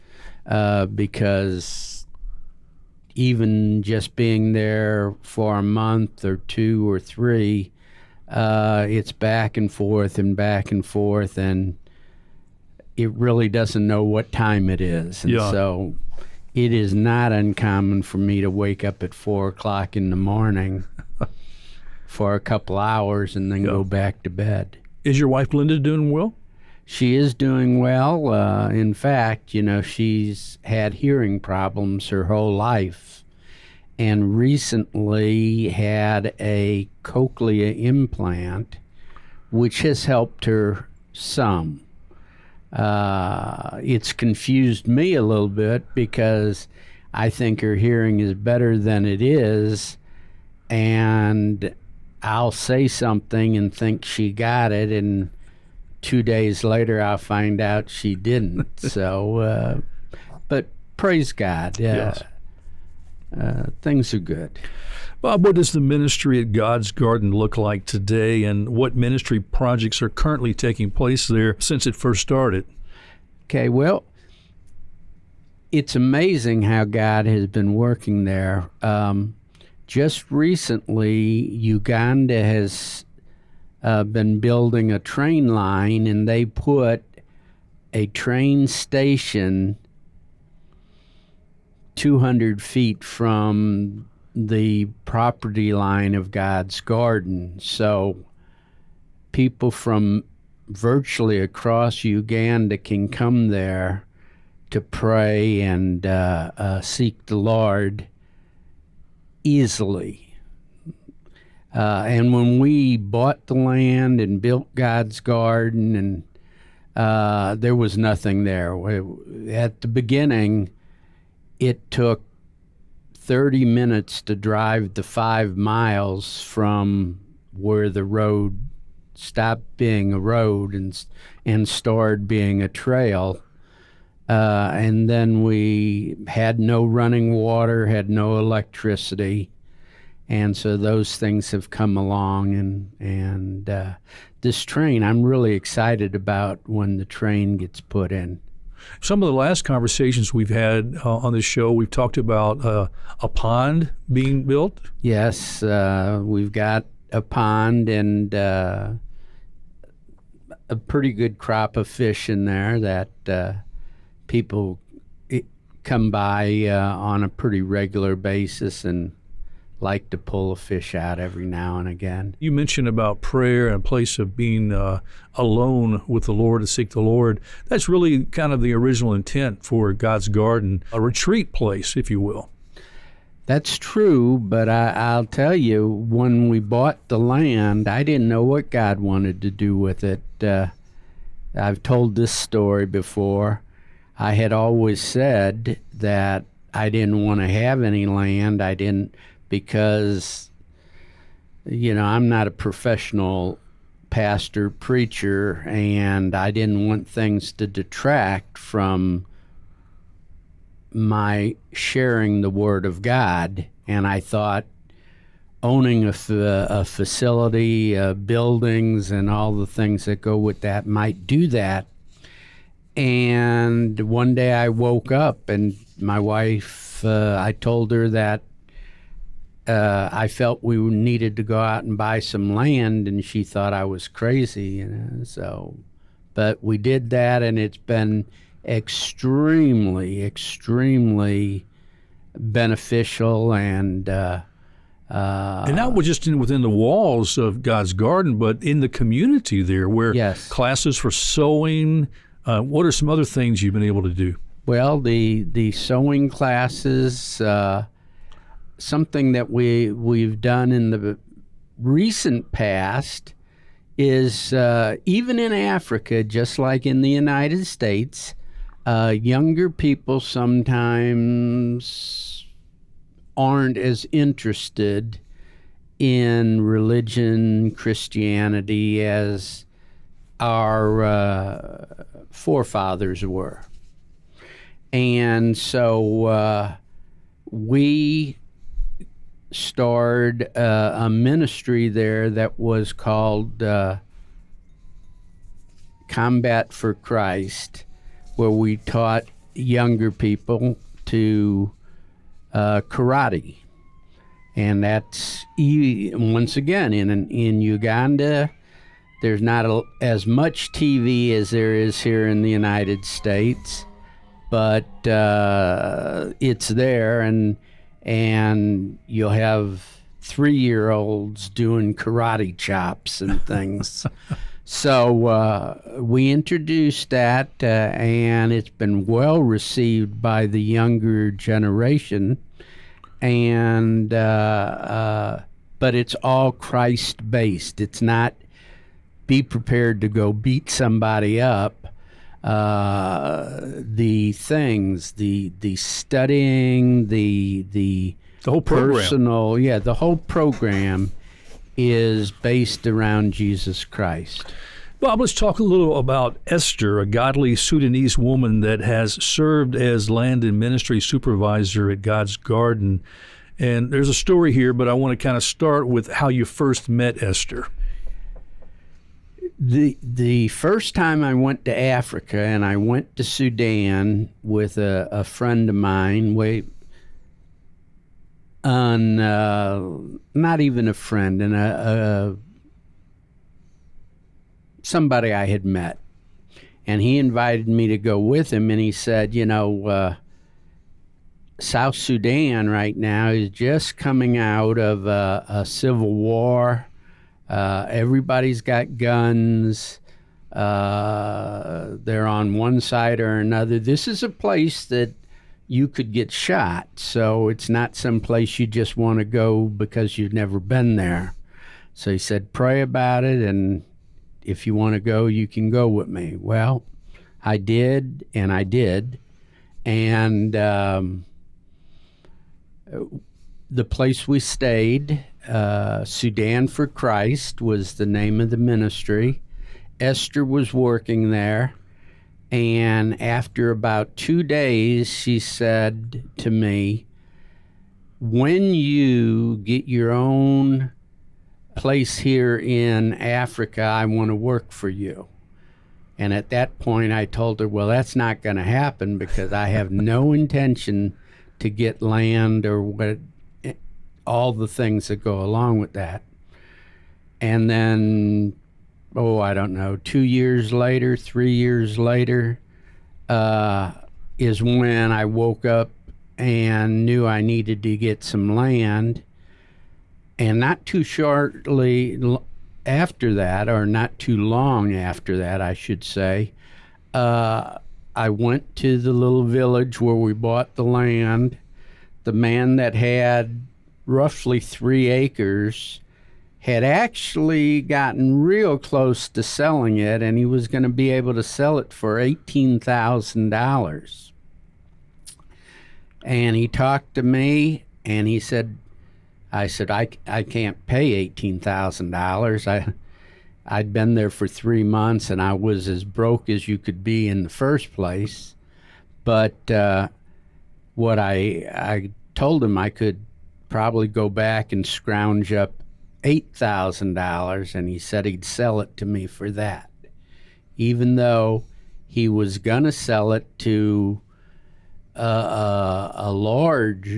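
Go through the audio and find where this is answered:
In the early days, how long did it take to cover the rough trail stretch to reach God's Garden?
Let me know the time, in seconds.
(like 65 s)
123 s.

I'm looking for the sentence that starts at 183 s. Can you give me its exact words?
That's true, but I, will tell you, when we bought the land, I didn't know what God wanted to do with it.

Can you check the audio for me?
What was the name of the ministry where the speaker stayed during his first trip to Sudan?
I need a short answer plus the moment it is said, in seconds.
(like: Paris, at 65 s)
Sudan for Christ, at 426 s.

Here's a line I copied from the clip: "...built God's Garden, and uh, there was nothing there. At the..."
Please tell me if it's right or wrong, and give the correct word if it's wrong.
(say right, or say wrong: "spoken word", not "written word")
right.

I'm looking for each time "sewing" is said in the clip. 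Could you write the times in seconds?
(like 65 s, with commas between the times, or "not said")
251 s, 255 s.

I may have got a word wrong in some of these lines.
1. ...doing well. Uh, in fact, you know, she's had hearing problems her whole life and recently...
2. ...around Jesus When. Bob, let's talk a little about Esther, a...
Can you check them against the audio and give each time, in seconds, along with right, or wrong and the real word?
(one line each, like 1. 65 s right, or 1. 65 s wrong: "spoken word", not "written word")
1. 27 s right
2. 352 s wrong: "Christ", not "When".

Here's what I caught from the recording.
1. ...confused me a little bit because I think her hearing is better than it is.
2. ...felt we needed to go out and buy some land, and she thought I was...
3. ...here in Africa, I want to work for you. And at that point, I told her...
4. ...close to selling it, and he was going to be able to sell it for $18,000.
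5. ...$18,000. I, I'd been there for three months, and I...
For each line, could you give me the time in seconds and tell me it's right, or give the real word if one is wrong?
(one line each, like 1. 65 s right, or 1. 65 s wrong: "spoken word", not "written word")
1. 44 s right
2. 230 s right
3. 442 s right
4. 488 s right
5. 501 s right.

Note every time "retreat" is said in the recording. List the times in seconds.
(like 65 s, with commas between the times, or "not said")
180 s.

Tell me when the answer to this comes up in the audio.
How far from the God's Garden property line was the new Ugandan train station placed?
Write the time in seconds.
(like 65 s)
91 s.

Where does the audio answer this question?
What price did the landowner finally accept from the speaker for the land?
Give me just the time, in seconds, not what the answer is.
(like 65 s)
516 s.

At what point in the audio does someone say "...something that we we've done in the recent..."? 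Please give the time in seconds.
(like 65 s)
258 s.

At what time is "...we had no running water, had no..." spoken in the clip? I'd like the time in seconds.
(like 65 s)
135 s.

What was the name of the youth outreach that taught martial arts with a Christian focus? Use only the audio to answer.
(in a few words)
Combat for Christ.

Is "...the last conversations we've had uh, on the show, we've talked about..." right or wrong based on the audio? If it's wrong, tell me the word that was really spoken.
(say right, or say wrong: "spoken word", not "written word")
right.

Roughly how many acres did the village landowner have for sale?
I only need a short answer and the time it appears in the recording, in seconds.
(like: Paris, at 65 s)
3 acres, at 484 s.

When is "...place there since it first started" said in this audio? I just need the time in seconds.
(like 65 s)
70 s.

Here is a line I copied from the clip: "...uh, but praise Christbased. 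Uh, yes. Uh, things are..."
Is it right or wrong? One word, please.
wrong.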